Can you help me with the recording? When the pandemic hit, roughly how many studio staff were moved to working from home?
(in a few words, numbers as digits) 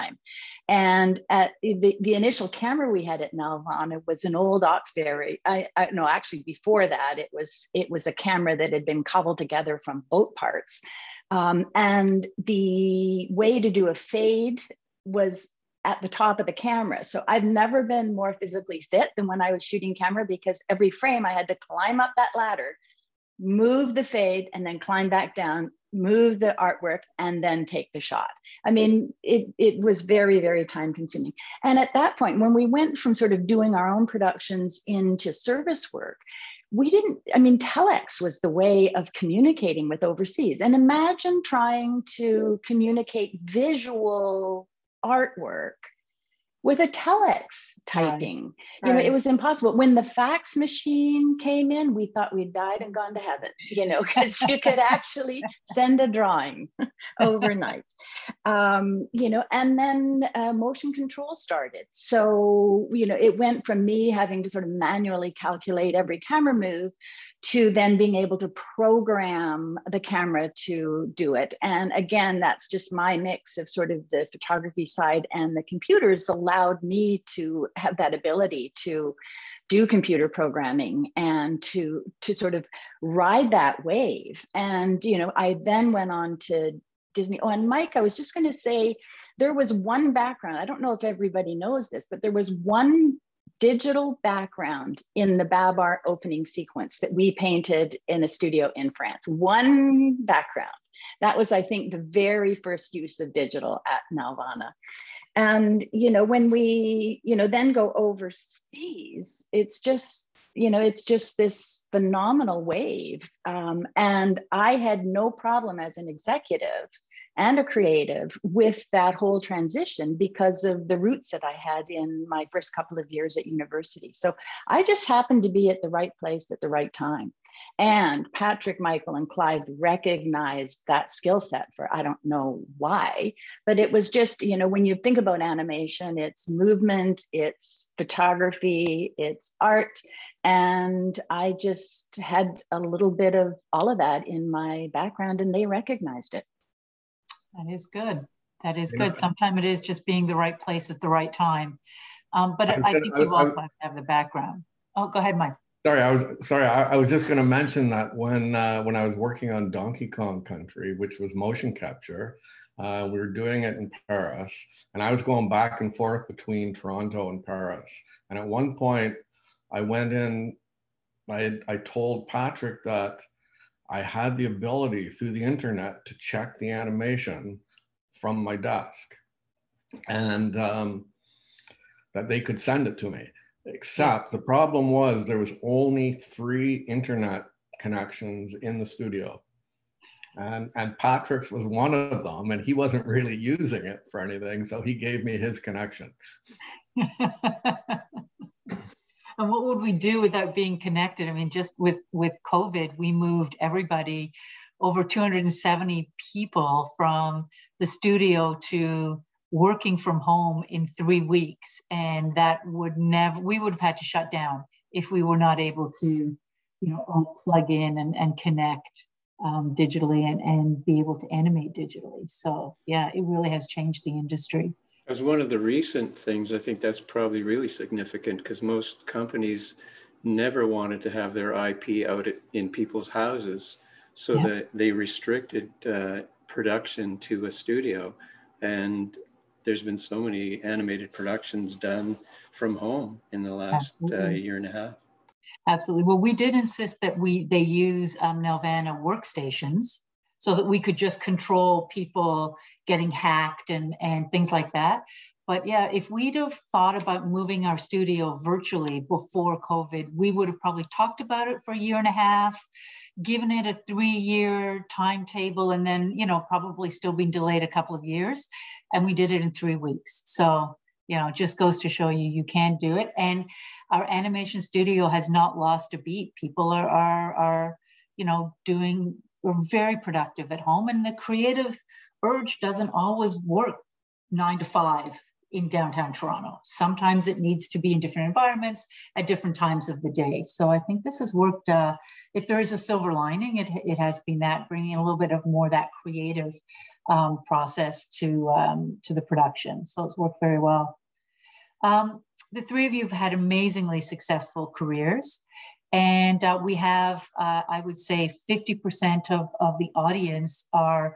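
270.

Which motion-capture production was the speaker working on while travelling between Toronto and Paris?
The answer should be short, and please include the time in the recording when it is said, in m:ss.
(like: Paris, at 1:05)
Donkey Kong Country, at 2:39.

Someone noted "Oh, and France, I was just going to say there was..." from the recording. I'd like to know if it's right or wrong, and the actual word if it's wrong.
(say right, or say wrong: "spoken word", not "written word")
wrong: "Mike", not "France".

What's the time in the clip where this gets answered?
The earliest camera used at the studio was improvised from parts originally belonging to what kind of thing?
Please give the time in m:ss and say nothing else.
0:10.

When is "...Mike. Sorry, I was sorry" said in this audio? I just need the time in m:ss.
2:35.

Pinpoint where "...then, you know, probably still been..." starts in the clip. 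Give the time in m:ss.
4:25.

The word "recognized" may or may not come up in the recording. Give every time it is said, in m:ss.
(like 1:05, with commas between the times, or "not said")
2:09, 2:25.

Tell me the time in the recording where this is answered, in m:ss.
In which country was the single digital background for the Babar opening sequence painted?
1:38.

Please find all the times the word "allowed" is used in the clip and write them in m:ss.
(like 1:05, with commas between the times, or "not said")
1:16.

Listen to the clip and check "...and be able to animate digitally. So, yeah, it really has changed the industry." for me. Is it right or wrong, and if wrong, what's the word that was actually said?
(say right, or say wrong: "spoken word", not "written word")
right.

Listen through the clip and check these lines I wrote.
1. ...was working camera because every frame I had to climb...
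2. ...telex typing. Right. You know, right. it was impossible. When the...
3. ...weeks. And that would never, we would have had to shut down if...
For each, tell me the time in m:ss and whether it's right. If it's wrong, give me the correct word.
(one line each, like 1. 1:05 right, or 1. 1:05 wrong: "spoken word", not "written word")
1. 0:19 wrong: "shooting", not "working"
2. 0:46 right
3. 3:31 right.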